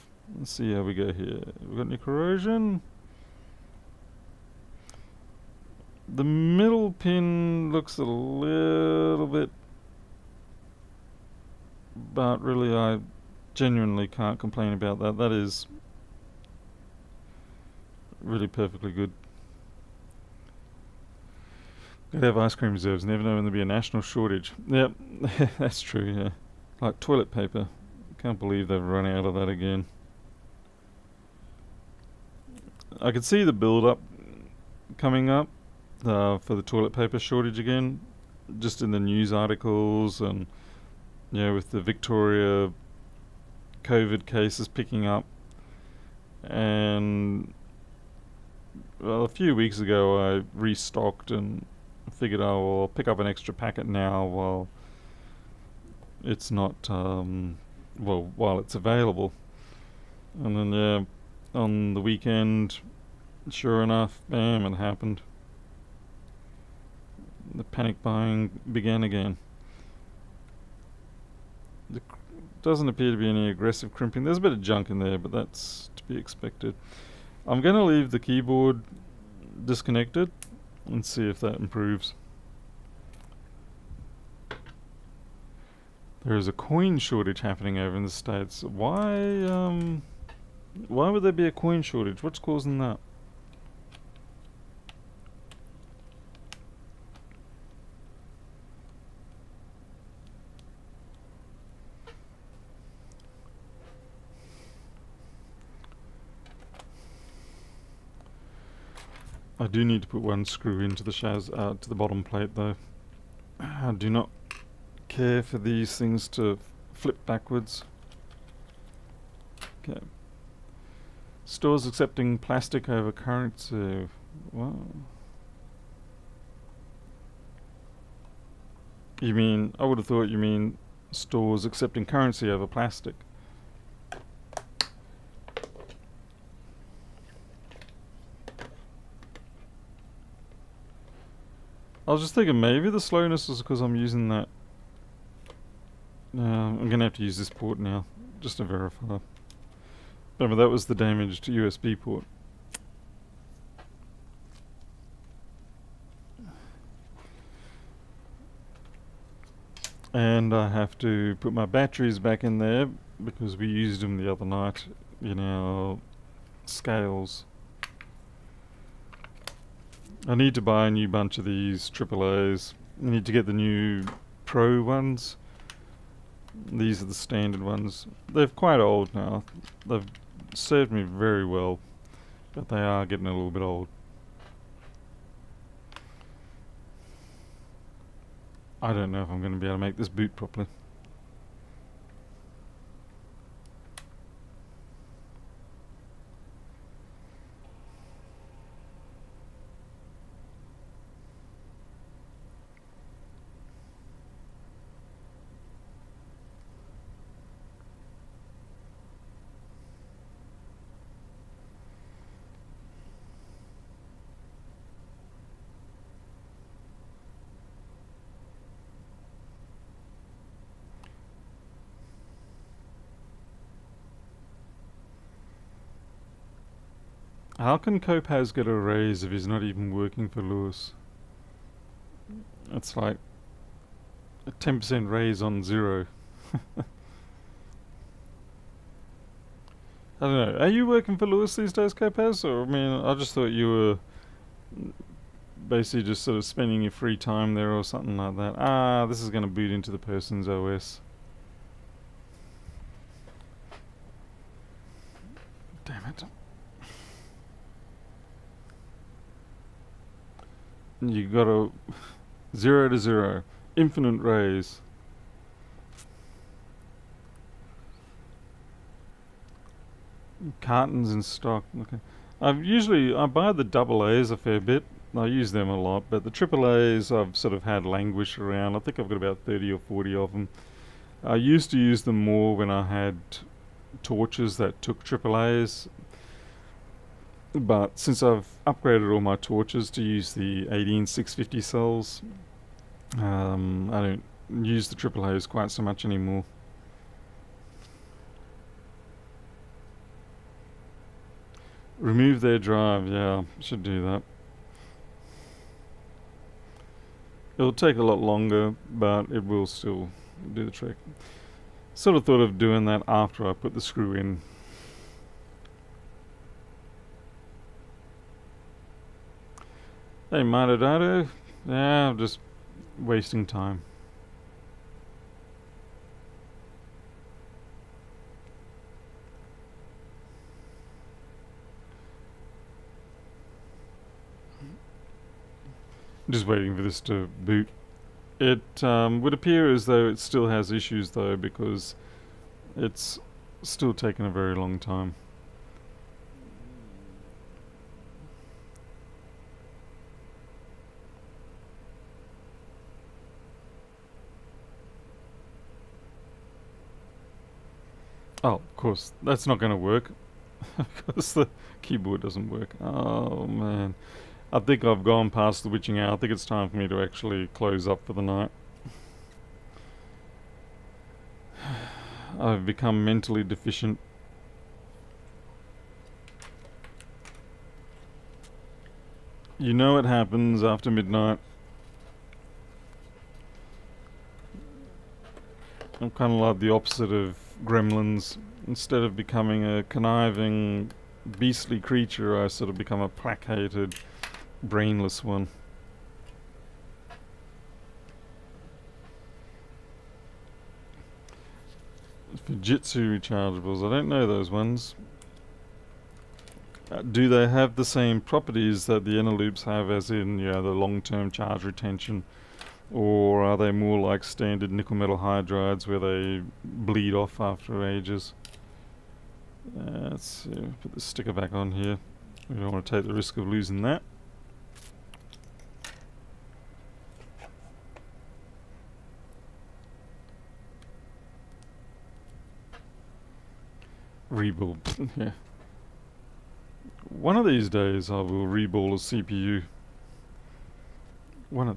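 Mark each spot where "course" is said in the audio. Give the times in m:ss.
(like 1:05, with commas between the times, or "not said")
5:58.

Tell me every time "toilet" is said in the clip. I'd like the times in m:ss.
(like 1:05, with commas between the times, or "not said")
0:26, 0:36.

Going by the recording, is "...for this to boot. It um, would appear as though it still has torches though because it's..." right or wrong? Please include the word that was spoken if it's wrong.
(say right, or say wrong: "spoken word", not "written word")
wrong: "issues", not "torches".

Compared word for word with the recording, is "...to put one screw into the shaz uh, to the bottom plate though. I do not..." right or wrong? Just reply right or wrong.
right.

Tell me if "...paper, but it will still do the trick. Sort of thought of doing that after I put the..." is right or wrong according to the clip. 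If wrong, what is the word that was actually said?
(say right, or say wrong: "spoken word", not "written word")
wrong: "longer", not "paper".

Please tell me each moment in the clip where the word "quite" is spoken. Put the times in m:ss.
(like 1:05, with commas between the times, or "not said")
2:58, 4:55.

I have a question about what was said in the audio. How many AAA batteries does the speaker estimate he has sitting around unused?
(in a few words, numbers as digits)
30 or 40.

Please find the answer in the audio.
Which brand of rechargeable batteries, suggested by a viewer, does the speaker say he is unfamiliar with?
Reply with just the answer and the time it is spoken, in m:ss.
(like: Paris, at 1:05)
Fujitsu, at 6:42.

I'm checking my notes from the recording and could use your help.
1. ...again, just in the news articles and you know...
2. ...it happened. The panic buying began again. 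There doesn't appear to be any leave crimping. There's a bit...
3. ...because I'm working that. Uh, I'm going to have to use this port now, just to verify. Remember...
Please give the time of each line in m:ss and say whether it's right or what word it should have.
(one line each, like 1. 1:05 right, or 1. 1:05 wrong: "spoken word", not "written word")
1. 0:37 right
2. 1:04 wrong: "aggressive", not "leave"
3. 2:23 wrong: "using", not "working".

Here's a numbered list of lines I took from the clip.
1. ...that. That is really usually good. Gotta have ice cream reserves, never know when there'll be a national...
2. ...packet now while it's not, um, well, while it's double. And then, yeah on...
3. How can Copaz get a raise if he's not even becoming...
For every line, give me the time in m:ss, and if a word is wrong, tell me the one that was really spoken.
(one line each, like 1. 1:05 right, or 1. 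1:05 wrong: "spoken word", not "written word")
1. 0:14 wrong: "perfectly", not "usually"
2. 0:53 wrong: "available", not "double"
3. 3:47 wrong: "working", not "becoming".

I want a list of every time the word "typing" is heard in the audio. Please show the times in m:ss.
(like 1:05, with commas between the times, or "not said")
not said.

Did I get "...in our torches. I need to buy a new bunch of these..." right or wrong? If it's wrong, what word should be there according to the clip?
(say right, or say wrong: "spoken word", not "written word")
wrong: "scales", not "torches".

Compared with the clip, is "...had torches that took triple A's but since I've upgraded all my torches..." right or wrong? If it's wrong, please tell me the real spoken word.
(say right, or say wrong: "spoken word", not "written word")
right.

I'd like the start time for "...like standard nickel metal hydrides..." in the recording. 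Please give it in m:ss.
6:53.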